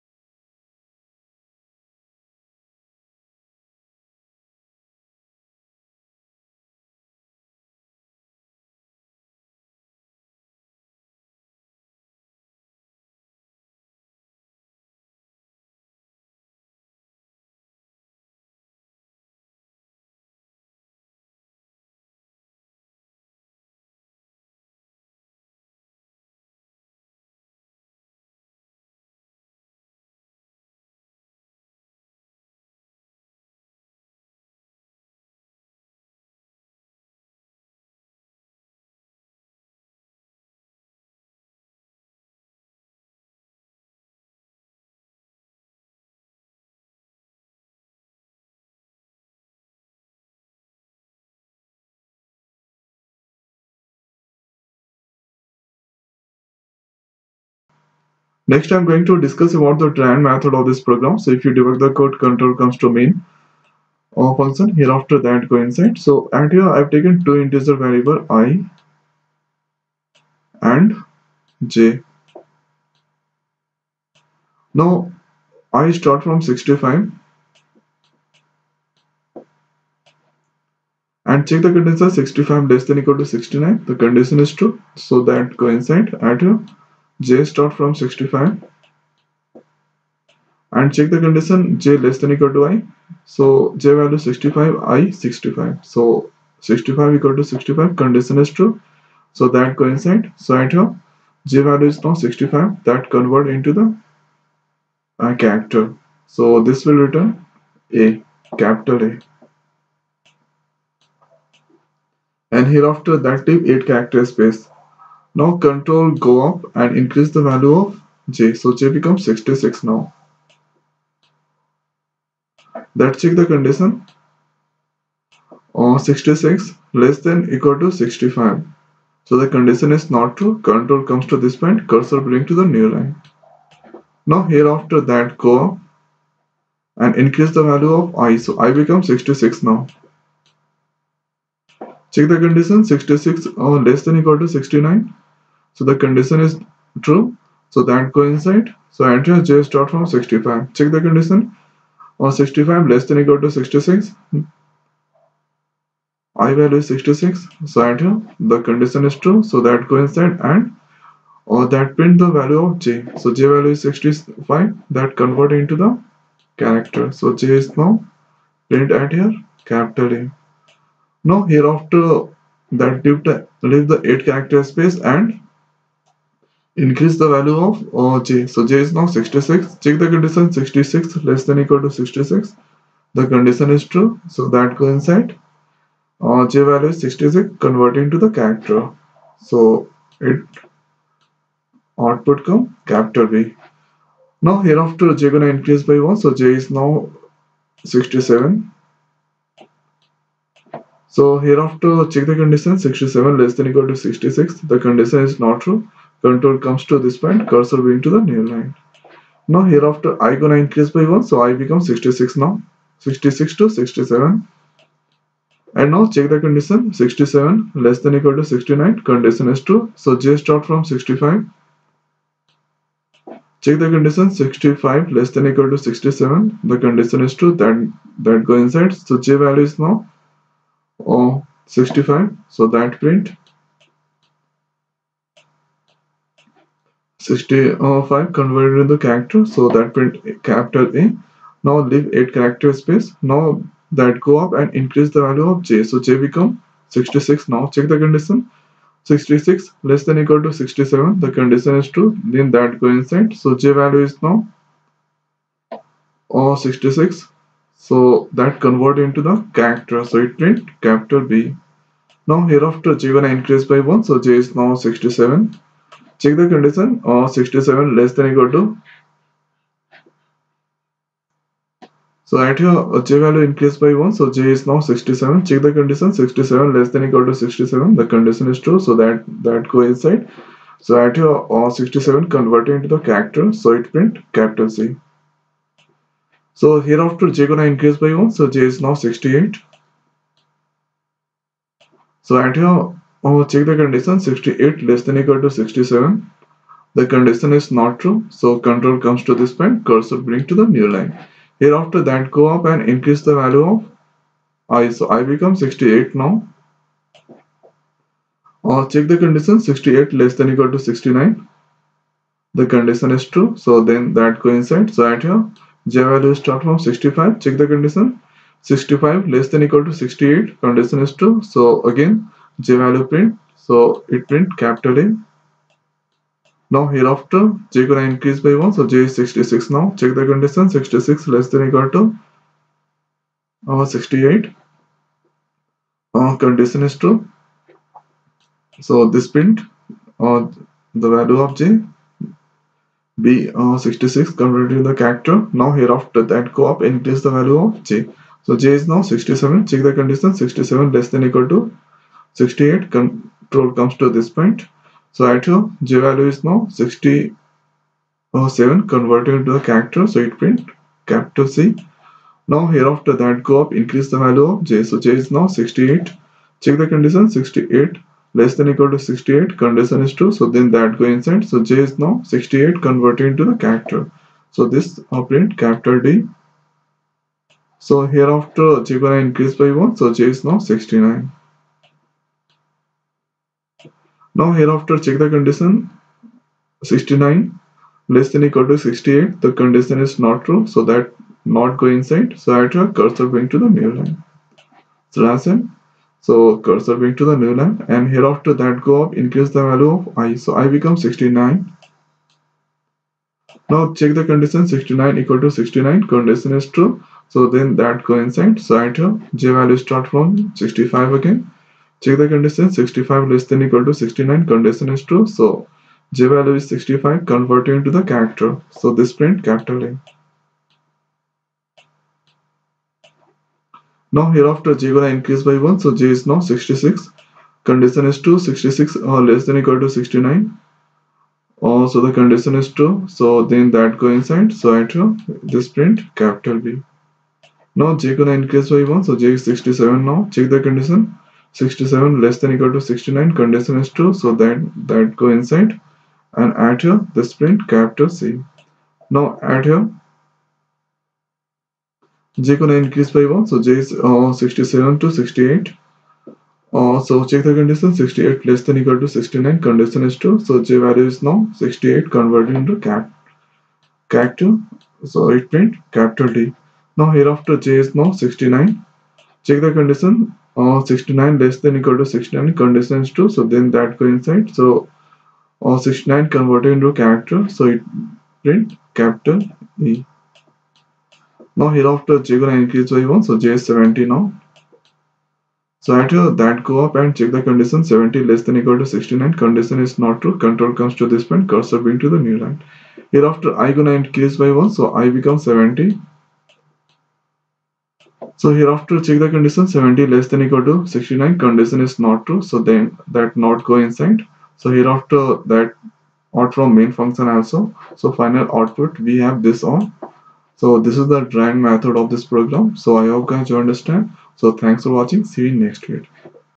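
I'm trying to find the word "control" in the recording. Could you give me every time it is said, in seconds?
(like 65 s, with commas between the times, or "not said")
62 s, 115 s, 130 s, 206 s, 298 s, 352 s, 490 s.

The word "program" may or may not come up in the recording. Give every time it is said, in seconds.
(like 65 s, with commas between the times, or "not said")
60 s, 512 s.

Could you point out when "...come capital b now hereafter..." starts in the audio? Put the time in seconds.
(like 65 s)
192 s.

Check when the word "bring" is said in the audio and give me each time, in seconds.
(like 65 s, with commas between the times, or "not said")
132 s, 300 s.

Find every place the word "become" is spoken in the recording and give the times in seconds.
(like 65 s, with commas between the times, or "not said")
118 s, 138 s, 211 s, 246 s, 305 s, 400 s, 495 s.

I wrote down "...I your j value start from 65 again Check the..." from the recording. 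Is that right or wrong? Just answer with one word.
right.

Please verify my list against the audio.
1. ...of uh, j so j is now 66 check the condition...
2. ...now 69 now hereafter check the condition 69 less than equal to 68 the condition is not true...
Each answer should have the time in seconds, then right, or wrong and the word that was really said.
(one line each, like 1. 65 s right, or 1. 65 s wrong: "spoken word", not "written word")
1. 177 s right
2. 380 s right.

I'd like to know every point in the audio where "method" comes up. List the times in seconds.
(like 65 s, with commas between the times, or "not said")
60 s, 511 s.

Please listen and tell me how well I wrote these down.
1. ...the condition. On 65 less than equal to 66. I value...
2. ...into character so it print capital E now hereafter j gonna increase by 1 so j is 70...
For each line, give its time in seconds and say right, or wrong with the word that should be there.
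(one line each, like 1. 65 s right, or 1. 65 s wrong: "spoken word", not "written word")
1. 150 s right
2. 476 s right.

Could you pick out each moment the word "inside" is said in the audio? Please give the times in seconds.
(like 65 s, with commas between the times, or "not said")
228 s, 252 s, 371 s, 391 s, 408 s, 434 s, 445 s, 503 s.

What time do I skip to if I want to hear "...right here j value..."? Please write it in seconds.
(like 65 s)
100 s.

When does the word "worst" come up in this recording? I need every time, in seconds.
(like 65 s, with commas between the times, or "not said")
not said.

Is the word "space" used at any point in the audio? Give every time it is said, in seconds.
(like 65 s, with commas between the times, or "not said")
114 s, 174 s, 242 s.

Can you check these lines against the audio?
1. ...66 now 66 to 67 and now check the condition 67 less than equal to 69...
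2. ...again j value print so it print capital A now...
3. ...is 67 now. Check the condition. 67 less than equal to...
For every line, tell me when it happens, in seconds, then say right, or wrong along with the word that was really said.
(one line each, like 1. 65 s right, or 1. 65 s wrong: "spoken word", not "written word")
1. 211 s right
2. 321 s right
3. 439 s right.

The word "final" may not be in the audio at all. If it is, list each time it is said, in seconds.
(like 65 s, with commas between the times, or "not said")
508 s.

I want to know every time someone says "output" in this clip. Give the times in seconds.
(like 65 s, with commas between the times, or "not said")
191 s, 508 s.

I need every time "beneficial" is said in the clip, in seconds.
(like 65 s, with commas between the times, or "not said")
not said.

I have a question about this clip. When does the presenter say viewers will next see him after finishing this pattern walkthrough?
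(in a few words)
Next week.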